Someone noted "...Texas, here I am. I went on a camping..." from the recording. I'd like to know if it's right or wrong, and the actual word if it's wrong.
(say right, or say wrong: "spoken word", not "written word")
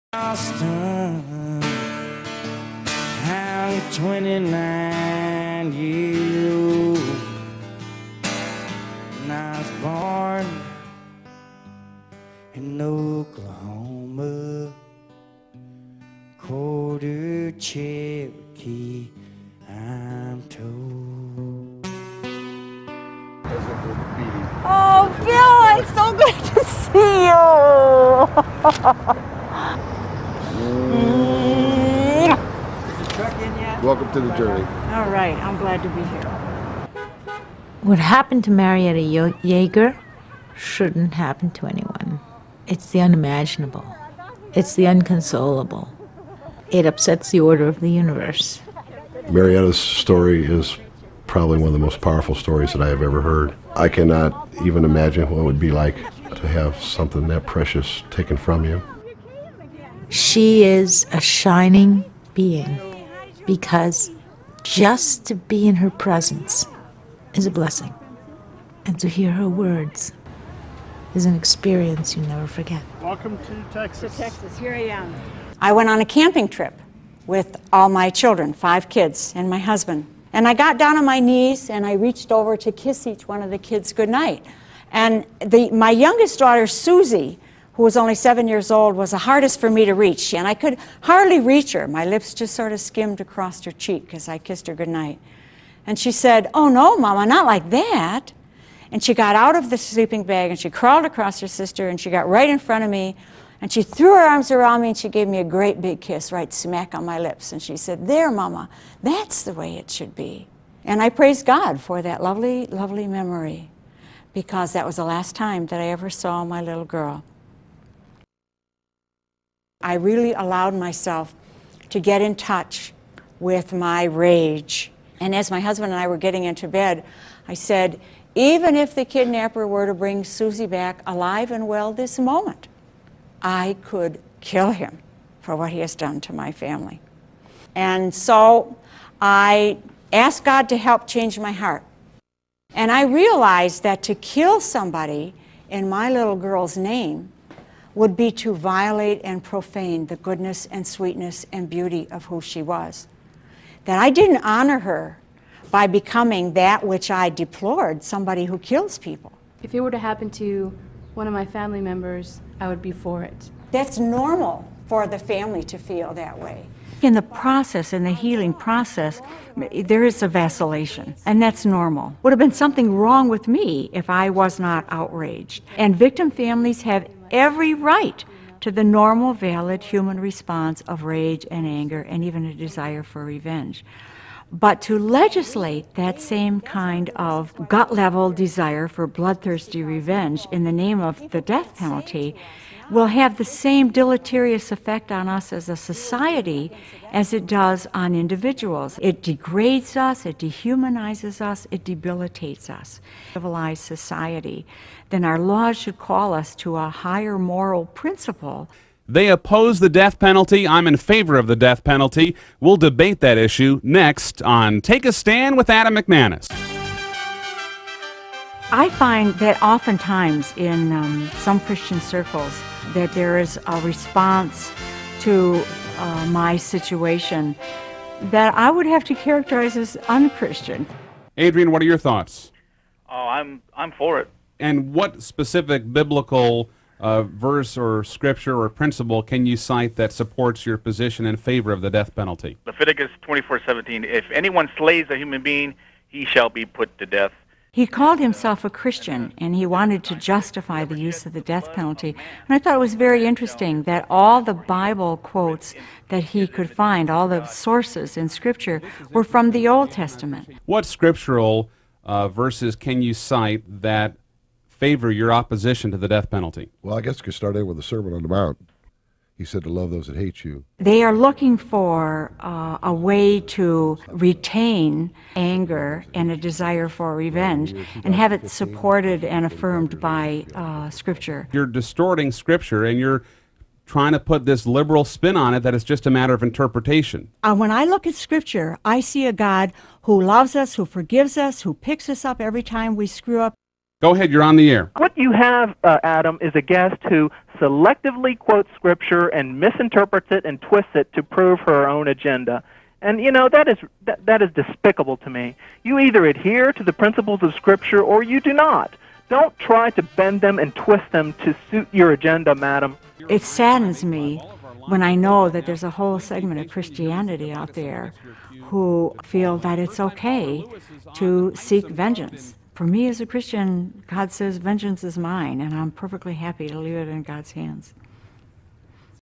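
right.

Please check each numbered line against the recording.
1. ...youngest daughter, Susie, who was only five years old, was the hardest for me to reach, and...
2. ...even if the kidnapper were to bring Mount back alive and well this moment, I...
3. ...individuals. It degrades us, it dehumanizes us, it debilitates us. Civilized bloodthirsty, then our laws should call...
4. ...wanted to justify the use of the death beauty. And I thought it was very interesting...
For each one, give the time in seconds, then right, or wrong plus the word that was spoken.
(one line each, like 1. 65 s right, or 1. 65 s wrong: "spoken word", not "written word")
1. 85 s wrong: "seven", not "five"
2. 128 s wrong: "Susie", not "Mount"
3. 198 s wrong: "society", not "bloodthirsty"
4. 249 s wrong: "penalty", not "beauty".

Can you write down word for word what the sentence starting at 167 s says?
In the process, in the healing process, there is a vacillation, and that's normal.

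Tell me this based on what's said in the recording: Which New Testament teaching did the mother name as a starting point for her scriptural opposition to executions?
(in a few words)
The Sermon on the Mount.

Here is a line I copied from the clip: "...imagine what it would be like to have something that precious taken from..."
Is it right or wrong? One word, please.
right.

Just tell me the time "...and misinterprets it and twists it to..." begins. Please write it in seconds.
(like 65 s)
299 s.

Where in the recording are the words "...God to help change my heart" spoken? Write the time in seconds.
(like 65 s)
140 s.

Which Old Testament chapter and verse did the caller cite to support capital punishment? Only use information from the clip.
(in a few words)
Leviticus 24:17.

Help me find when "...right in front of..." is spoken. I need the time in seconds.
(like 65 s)
102 s.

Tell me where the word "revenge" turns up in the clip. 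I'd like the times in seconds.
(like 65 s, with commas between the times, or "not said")
183 s, 189 s, 277 s.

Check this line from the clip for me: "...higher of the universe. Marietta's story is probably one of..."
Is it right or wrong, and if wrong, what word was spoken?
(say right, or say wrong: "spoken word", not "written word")
wrong: "order", not "higher".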